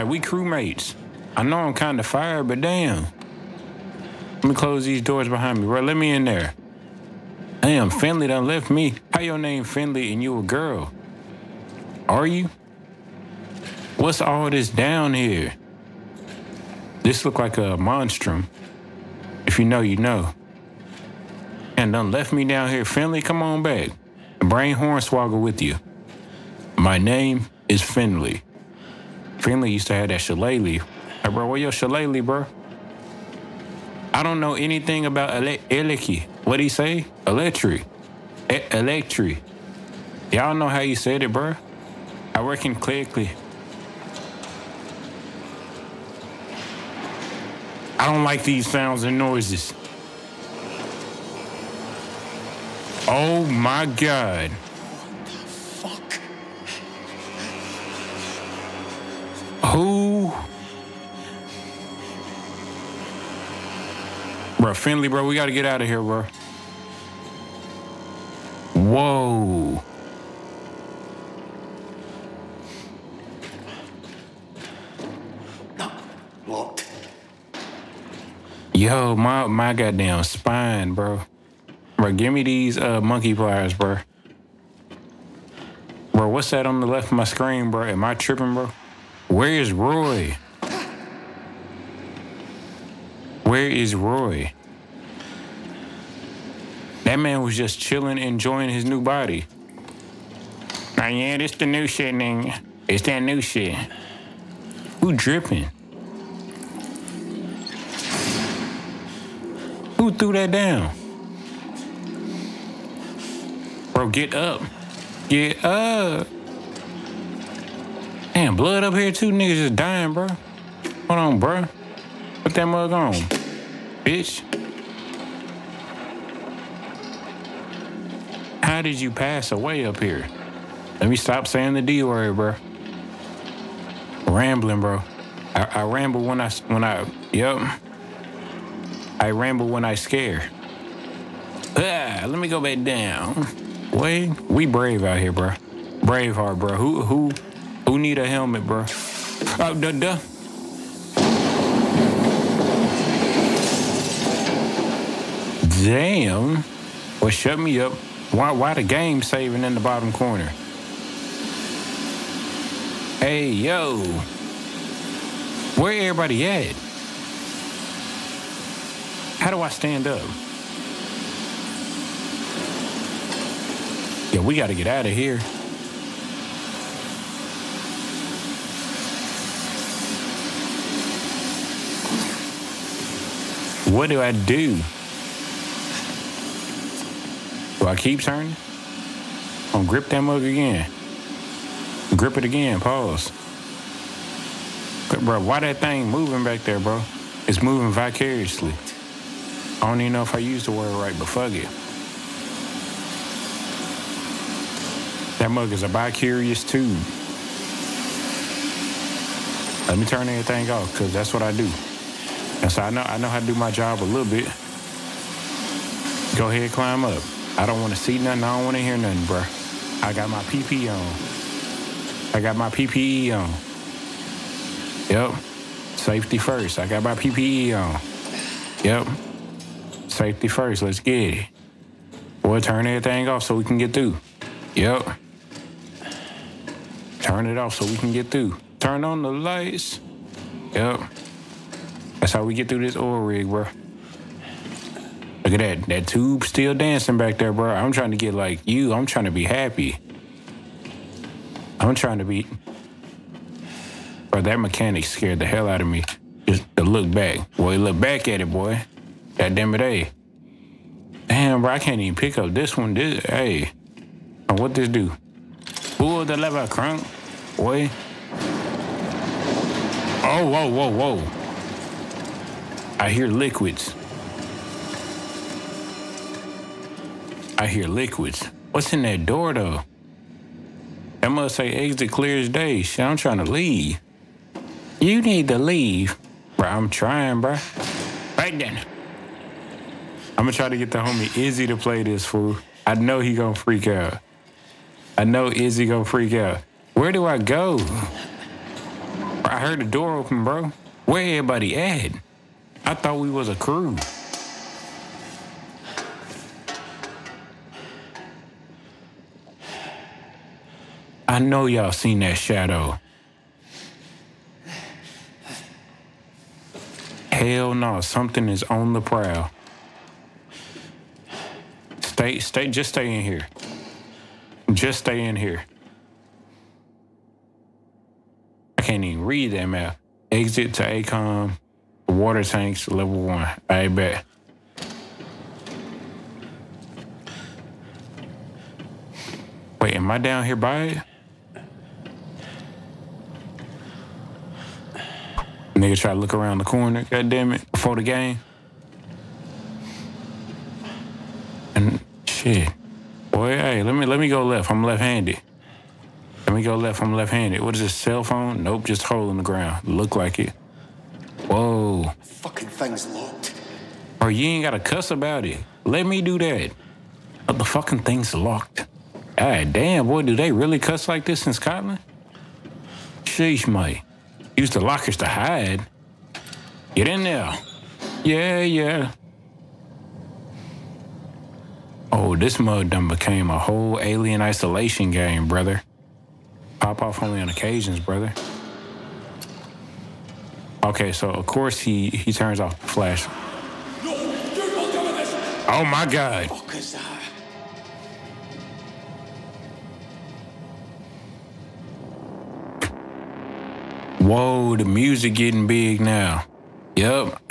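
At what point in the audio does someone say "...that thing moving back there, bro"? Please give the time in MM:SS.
03:15.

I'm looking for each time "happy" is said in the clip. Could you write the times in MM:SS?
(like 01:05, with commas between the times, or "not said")
04:09.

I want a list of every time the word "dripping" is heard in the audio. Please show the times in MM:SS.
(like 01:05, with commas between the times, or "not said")
01:45.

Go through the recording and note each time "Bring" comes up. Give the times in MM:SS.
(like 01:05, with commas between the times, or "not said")
00:24.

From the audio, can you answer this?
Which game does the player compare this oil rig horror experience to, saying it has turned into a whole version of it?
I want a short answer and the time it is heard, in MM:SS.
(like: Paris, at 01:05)
Alien Isolation, at 06:24.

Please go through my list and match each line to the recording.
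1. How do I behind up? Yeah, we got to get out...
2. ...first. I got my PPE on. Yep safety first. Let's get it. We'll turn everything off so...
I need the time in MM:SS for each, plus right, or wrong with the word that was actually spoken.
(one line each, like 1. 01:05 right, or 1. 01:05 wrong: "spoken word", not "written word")
1. 02:49 wrong: "stand", not "behind"
2. 03:46 right.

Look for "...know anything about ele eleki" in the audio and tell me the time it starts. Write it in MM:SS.
00:34.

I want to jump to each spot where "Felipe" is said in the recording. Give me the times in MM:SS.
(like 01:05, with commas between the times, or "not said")
not said.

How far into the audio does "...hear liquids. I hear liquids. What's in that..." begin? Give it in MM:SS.
04:33.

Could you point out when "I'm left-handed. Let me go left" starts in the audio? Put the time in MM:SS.
05:54.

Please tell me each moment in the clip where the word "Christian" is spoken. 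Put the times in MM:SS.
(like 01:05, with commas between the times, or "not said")
not said.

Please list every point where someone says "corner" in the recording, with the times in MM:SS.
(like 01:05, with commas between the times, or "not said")
02:40, 05:46.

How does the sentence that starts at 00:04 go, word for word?
Let me close these doors behind me, bro.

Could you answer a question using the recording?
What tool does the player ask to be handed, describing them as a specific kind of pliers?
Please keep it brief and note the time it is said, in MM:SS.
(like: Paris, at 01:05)
monkey pliers, at 01:22.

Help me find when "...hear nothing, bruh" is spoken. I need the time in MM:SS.
03:38.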